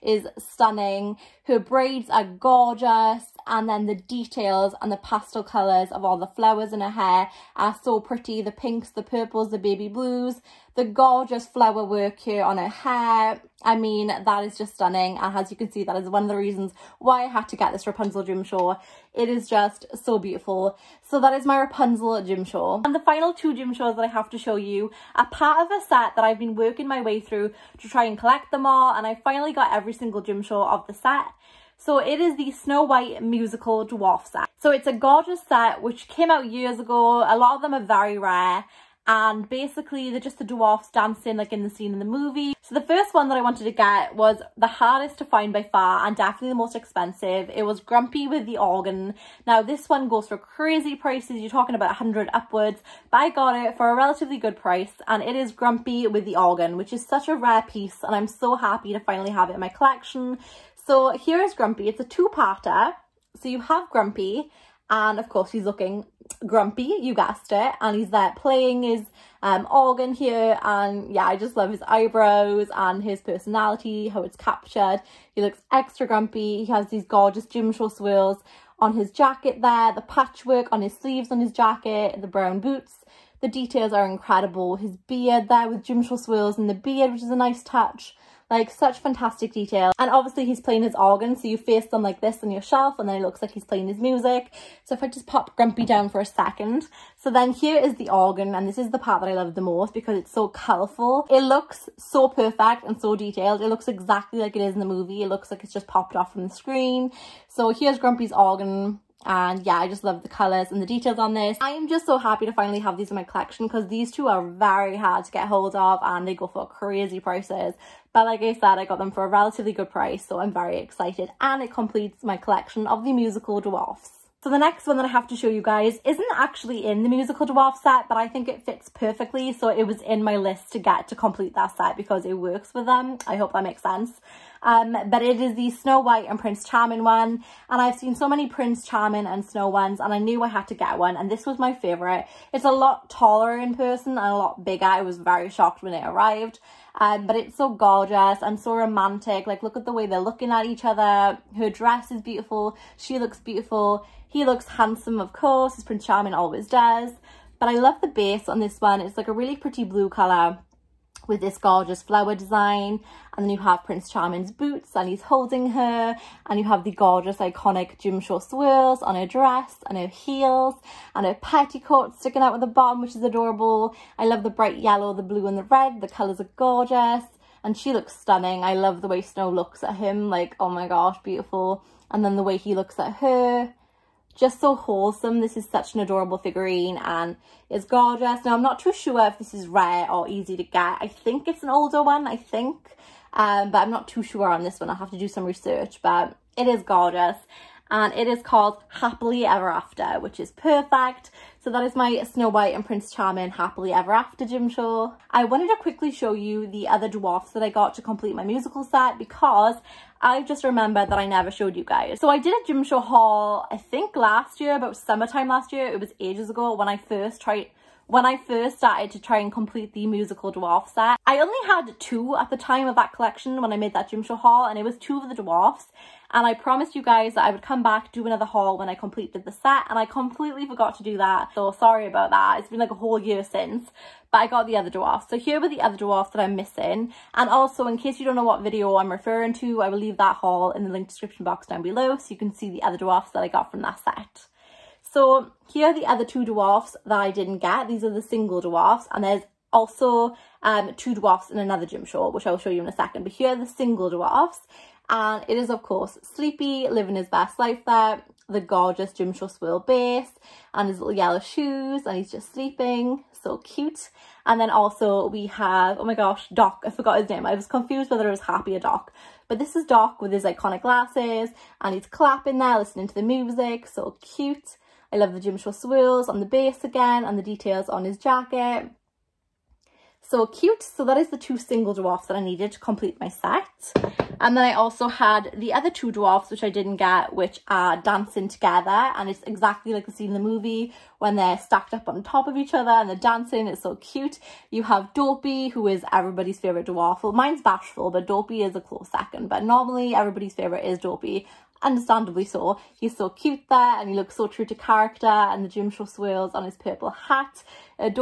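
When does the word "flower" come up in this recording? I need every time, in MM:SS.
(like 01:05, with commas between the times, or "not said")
00:06, 00:11, 02:42.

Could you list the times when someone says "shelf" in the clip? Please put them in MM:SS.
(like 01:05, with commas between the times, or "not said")
01:32.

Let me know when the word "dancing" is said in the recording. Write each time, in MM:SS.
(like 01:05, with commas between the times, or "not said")
00:40, 04:47, 04:53.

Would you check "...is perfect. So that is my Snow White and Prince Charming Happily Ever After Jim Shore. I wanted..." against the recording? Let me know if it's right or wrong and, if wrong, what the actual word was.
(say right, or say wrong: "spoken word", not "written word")
right.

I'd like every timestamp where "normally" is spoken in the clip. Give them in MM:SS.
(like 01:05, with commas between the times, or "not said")
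04:59.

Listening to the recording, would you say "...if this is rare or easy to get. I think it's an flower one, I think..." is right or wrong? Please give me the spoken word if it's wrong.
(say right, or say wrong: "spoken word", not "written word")
wrong: "older", not "flower".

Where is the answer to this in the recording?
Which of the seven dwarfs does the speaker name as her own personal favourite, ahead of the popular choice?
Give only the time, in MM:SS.
04:57.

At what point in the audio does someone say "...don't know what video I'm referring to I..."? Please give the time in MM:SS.
03:58.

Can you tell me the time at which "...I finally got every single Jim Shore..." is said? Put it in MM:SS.
00:29.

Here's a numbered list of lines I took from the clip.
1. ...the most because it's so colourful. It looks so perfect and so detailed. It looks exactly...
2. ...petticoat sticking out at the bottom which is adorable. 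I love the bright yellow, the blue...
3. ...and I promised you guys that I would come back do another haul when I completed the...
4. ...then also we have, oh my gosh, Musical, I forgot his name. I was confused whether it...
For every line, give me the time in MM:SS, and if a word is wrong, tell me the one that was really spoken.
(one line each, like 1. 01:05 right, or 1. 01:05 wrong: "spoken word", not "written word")
1. 01:39 right
2. 02:51 right
3. 03:46 right
4. 04:24 wrong: "Doc", not "Musical".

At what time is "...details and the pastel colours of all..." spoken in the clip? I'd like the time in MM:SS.
00:03.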